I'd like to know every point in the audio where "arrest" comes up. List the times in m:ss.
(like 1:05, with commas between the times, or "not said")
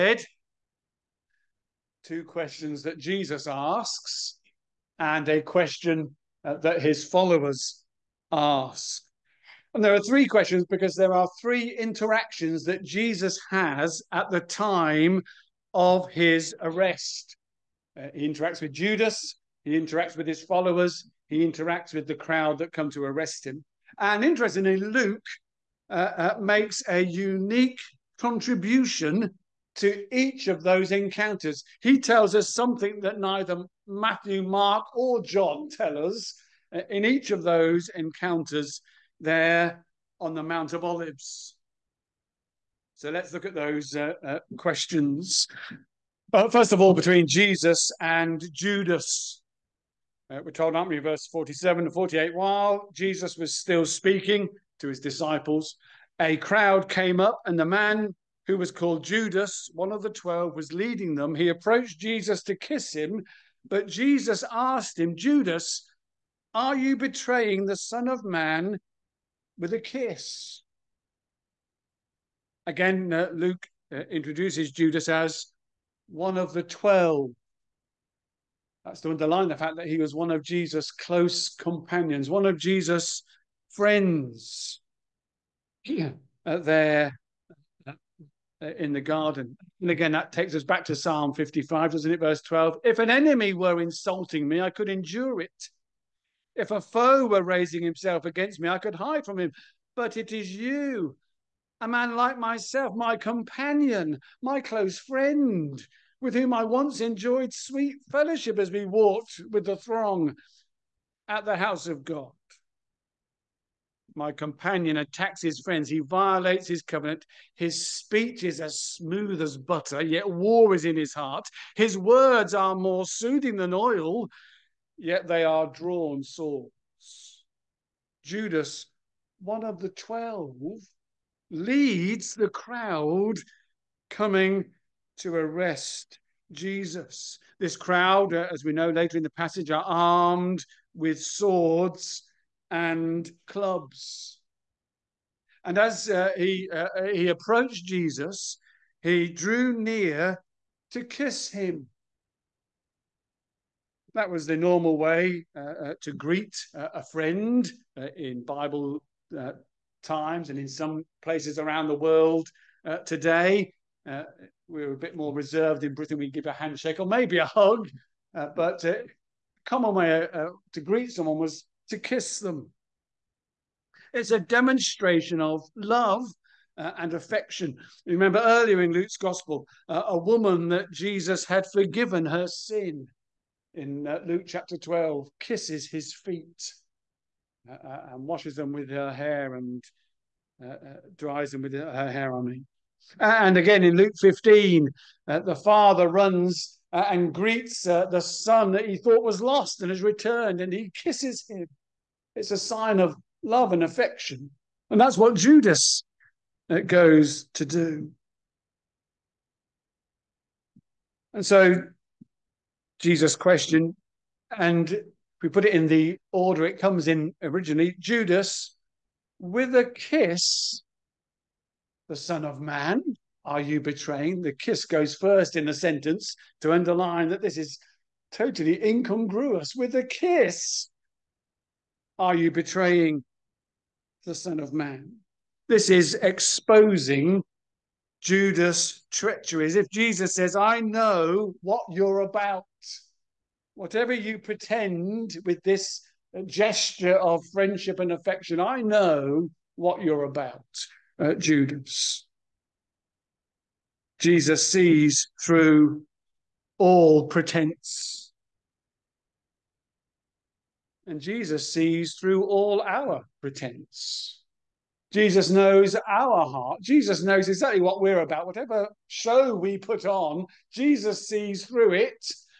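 0:16, 0:23, 2:15.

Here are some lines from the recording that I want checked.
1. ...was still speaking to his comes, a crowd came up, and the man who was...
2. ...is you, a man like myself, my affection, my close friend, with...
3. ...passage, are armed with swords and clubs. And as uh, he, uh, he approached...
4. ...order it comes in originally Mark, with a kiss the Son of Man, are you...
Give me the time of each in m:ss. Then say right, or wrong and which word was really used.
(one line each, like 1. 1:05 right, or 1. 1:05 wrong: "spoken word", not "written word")
1. 0:53 wrong: "disciples", not "comes"
2. 1:40 wrong: "companion", not "affection"
3. 2:19 right
4. 3:36 wrong: "Judas", not "Mark".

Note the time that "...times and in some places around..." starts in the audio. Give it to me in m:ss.
2:40.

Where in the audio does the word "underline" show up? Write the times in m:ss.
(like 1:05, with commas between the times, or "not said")
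1:19, 3:46.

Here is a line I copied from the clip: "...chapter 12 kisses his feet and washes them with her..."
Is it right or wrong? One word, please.
right.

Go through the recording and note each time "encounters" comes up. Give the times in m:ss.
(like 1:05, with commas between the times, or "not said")
0:30, 0:37.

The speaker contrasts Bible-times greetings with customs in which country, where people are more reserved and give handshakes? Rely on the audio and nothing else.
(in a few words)
Britain.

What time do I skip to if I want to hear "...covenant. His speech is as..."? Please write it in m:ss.
1:56.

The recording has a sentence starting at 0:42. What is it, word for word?
So let's look at those uh, uh, questions.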